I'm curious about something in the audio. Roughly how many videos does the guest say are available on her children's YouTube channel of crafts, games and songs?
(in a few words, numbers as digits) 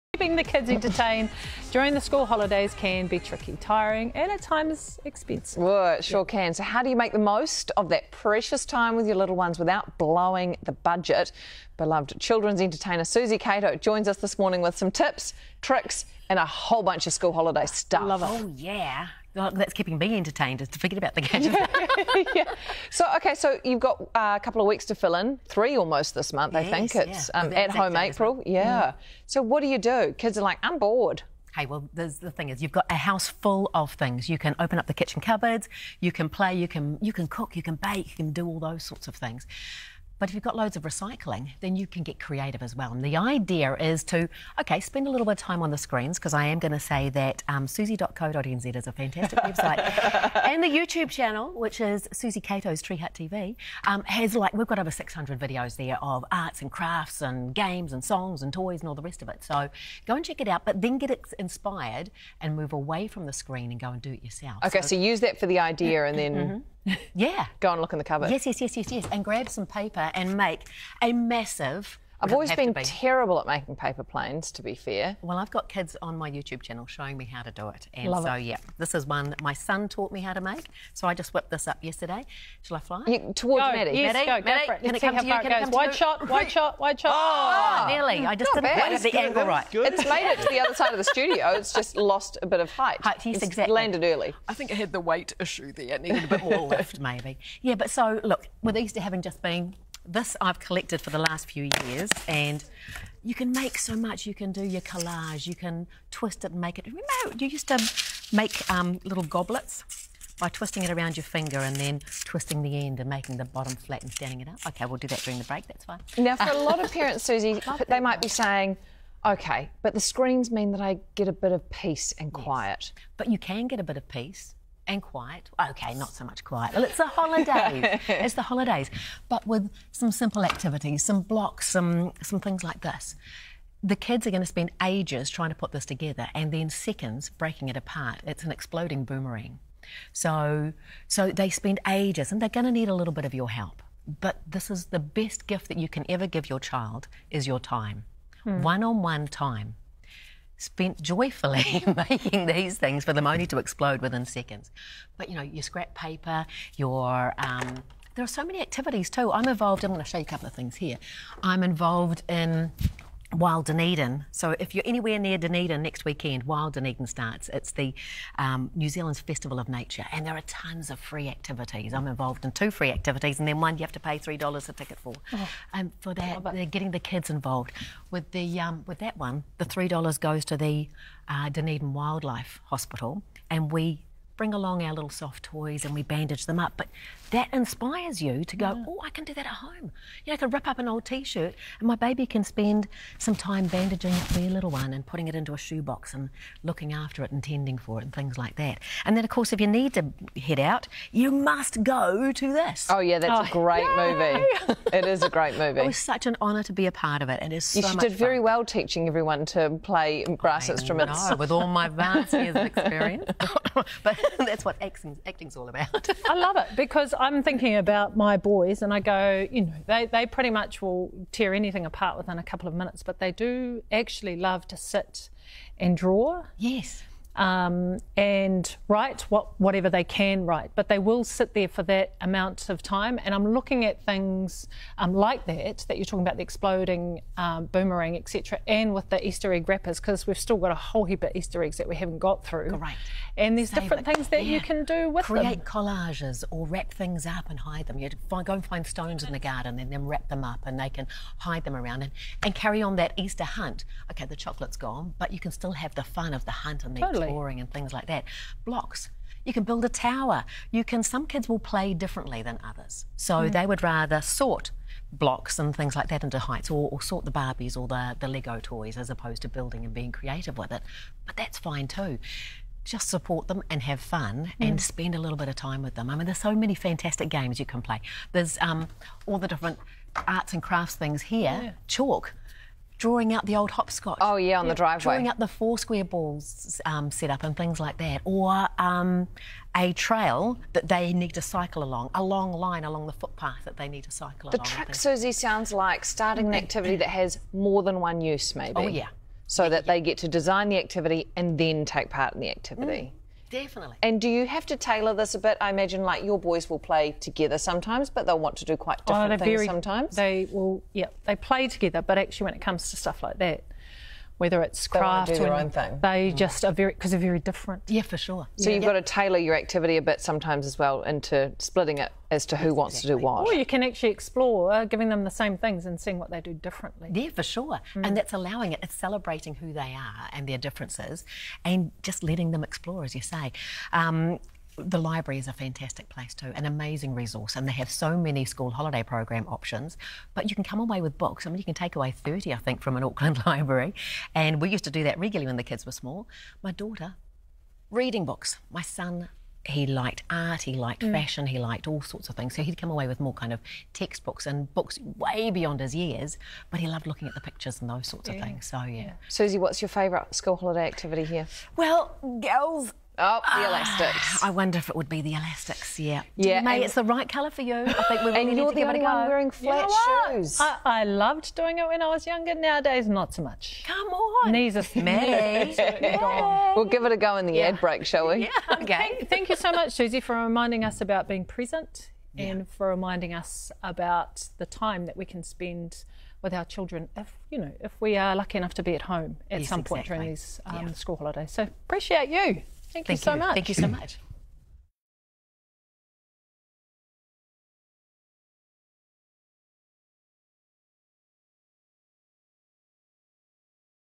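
over 600.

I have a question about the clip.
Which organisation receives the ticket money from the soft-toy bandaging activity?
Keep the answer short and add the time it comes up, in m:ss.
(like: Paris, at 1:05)
Dunedin Wildlife Hospital, at 3:01.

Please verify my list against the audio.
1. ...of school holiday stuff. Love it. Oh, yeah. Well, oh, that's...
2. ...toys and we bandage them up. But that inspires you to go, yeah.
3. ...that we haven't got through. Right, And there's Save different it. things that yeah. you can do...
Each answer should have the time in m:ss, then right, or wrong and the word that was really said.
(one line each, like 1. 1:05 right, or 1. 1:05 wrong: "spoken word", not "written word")
1. 0:17 right
2. 3:05 right
3. 4:01 right.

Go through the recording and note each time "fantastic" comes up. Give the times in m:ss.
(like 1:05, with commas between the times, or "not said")
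0:48, 4:36, 5:35.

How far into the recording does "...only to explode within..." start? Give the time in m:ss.
2:33.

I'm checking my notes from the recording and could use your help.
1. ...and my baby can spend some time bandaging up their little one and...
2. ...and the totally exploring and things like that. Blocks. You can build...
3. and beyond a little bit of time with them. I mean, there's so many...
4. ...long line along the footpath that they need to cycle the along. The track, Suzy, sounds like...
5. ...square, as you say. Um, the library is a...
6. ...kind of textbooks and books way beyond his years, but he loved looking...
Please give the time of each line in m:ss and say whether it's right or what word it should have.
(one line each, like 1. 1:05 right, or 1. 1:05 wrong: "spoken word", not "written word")
1. 3:11 right
2. 4:16 right
3. 4:34 wrong: "spend", not "beyond"
4. 4:52 right
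5. 5:32 wrong: "explore", not "square"
6. 5:53 right.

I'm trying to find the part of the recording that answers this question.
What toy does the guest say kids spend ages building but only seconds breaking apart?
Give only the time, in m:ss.
2:18.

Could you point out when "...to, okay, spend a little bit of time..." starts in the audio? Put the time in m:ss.
0:44.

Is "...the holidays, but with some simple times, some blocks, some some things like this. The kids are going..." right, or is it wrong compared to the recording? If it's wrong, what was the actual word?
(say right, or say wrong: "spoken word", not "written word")
wrong: "activities", not "times".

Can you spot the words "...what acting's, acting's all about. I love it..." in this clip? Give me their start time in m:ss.
3:34.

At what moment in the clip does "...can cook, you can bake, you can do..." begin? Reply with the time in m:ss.
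0:37.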